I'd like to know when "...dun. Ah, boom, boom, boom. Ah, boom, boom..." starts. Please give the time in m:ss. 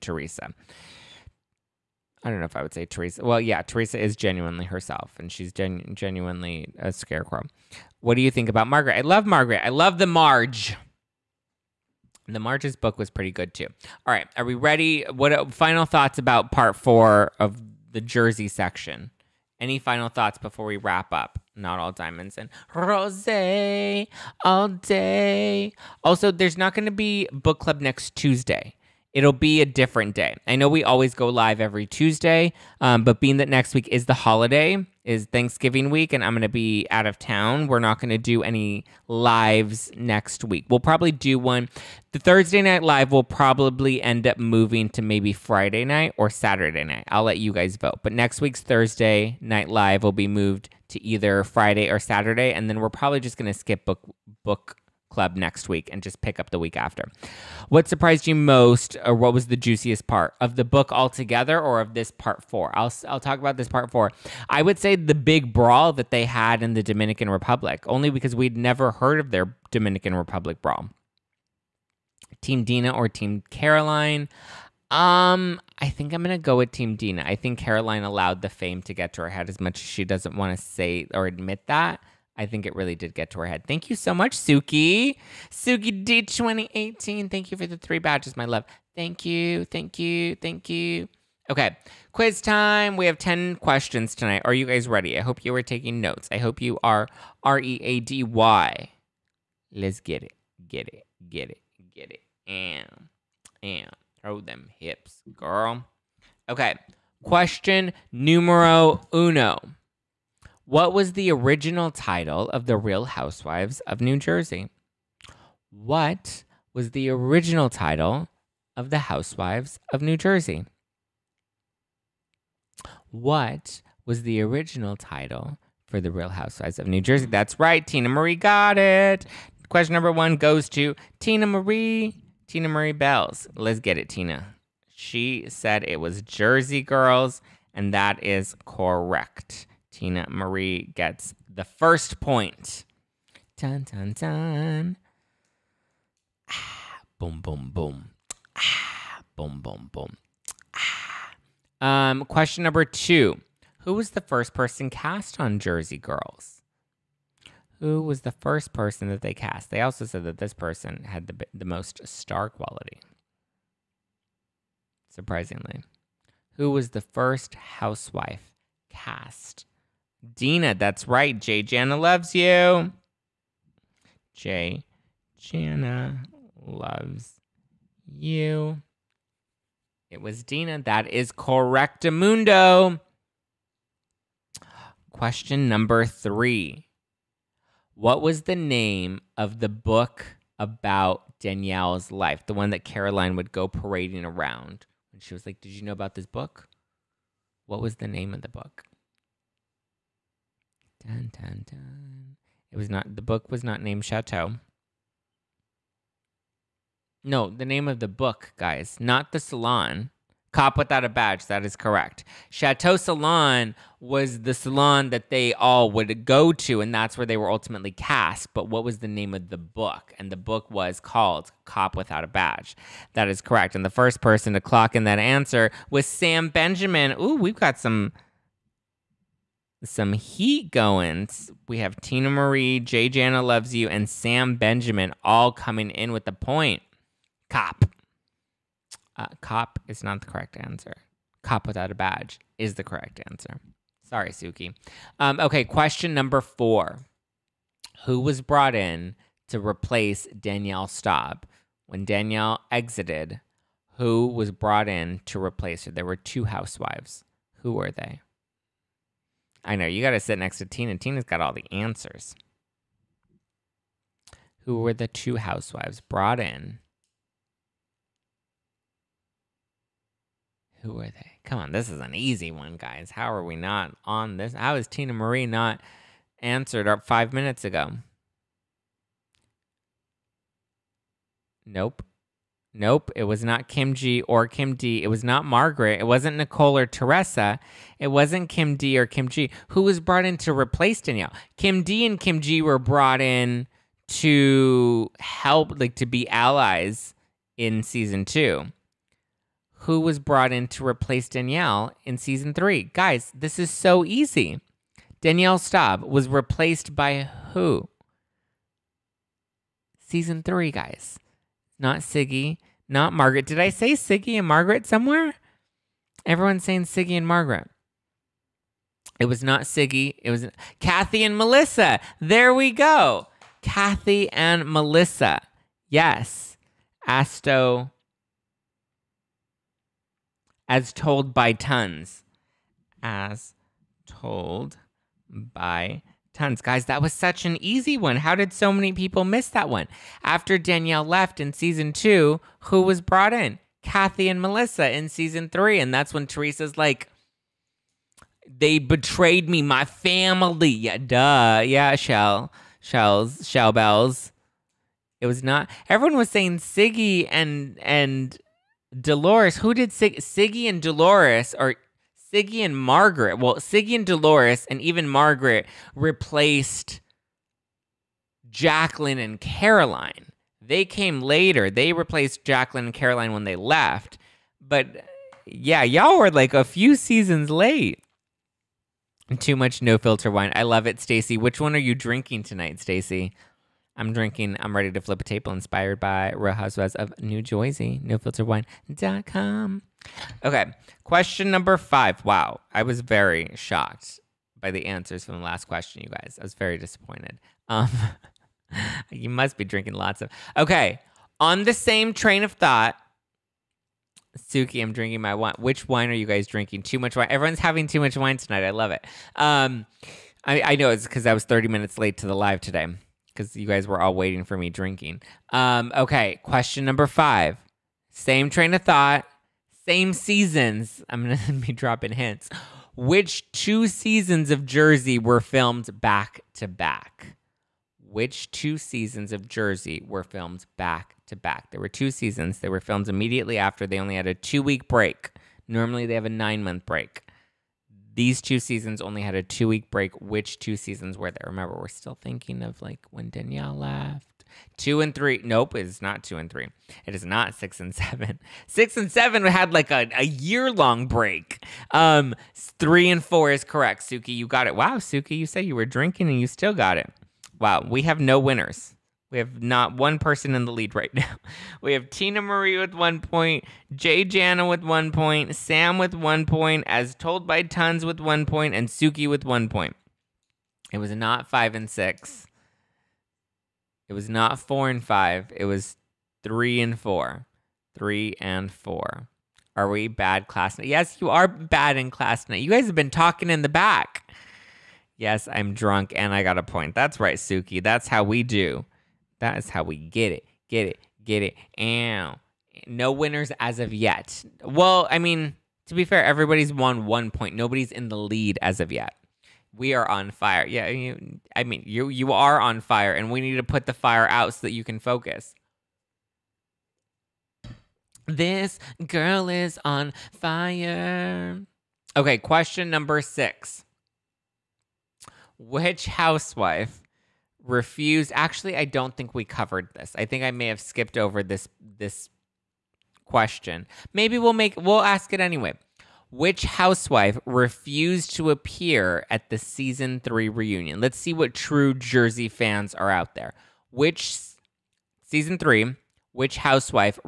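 2:24.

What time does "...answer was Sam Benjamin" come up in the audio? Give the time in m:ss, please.
3:45.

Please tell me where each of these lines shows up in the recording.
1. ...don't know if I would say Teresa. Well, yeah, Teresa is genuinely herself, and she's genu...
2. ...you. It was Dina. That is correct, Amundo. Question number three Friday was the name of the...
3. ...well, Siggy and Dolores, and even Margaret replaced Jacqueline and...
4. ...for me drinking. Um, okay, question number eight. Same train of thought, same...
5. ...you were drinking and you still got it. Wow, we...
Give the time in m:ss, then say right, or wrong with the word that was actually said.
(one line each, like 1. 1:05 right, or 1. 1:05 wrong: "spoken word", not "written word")
1. 0:02 right
2. 2:58 wrong: "What", not "Friday"
3. 6:03 right
4. 6:54 wrong: "five", not "eight"
5. 7:35 right.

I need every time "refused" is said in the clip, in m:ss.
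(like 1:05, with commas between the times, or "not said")
8:37, 8:47.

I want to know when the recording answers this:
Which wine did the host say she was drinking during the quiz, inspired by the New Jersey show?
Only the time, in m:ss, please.
6:24.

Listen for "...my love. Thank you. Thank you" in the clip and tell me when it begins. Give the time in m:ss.
1:28.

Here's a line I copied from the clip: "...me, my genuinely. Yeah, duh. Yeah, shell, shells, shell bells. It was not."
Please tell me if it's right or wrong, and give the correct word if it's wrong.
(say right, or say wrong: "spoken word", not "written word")
wrong: "family", not "genuinely".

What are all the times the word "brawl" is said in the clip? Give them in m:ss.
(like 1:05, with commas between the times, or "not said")
1:05, 1:10.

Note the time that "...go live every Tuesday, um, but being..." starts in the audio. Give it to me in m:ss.
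0:31.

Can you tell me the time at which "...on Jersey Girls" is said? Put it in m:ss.
2:35.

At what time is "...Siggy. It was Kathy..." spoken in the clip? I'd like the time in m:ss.
5:19.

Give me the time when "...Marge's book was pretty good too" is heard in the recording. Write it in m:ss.
0:12.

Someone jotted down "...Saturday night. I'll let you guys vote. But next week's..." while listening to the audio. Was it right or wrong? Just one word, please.
right.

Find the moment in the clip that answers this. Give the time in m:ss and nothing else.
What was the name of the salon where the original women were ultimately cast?
3:32.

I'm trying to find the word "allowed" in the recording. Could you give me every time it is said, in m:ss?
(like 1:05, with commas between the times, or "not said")
1:18.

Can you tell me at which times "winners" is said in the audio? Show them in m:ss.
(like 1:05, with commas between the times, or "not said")
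7:38, 8:13.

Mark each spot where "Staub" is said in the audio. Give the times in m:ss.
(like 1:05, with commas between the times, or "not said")
4:10, 5:05.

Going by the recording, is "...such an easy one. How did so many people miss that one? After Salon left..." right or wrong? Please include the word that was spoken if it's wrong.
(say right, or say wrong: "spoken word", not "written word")
wrong: "Danielle", not "Salon".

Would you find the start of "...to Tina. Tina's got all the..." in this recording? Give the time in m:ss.
4:20.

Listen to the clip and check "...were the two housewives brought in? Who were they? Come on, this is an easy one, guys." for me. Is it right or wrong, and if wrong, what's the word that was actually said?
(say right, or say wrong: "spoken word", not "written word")
right.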